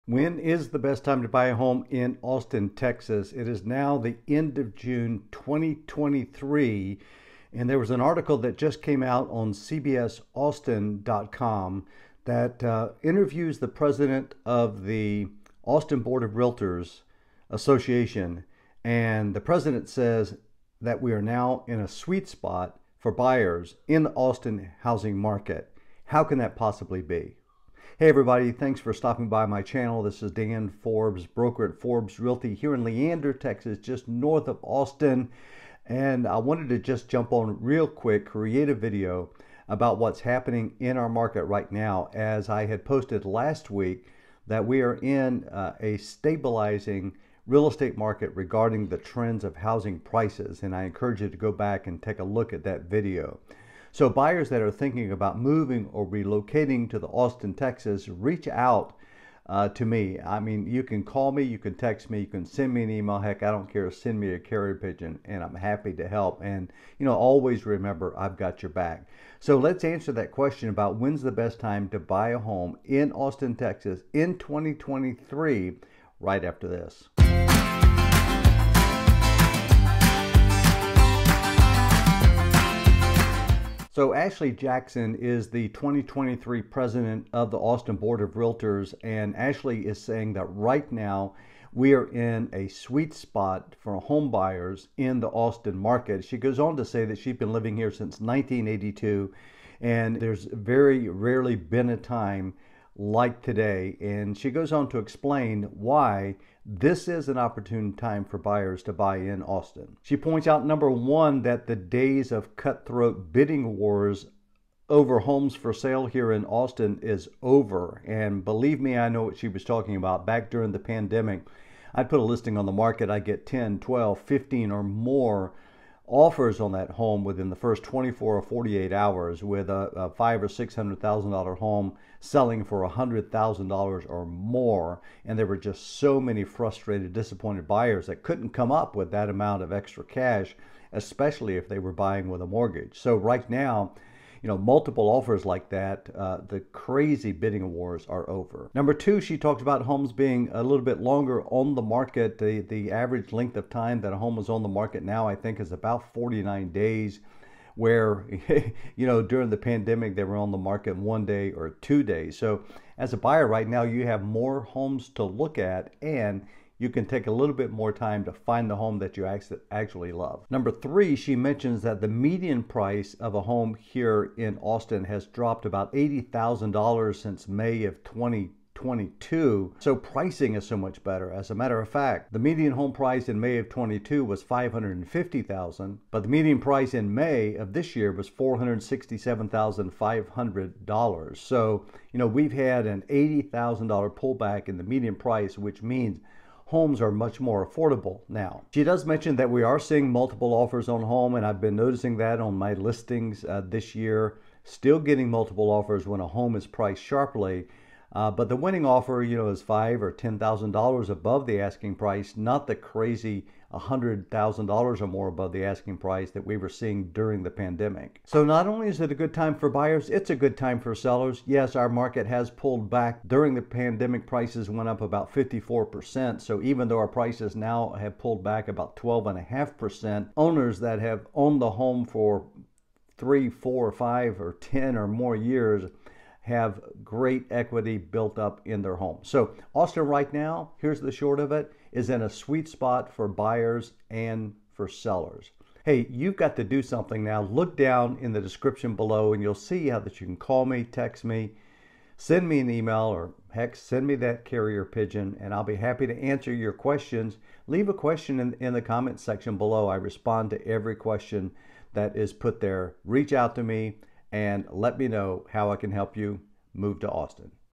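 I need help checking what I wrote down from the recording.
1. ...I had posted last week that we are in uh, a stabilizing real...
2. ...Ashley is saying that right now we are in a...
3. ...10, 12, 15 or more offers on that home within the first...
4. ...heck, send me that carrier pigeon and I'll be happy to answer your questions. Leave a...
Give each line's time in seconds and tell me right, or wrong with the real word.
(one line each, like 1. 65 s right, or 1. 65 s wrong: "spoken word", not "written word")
1. 42 s right
2. 89 s right
3. 123 s right
4. 253 s right.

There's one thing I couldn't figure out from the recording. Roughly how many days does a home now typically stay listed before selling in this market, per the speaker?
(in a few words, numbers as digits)
49.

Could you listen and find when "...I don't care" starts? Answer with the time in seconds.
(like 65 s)
63 s.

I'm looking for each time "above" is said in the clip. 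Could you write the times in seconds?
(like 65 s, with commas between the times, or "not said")
211 s, 215 s.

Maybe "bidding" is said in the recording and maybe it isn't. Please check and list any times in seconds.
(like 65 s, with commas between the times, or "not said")
113 s, 147 s.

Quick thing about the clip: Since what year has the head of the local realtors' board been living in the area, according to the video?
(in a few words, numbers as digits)
1982.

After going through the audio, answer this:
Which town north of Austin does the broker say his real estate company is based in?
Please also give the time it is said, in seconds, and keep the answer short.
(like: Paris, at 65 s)
Leander, at 32 s.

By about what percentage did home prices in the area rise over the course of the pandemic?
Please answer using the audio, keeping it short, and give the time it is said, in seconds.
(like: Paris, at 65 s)
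54%, at 225 s.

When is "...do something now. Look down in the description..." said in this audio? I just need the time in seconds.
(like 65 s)
246 s.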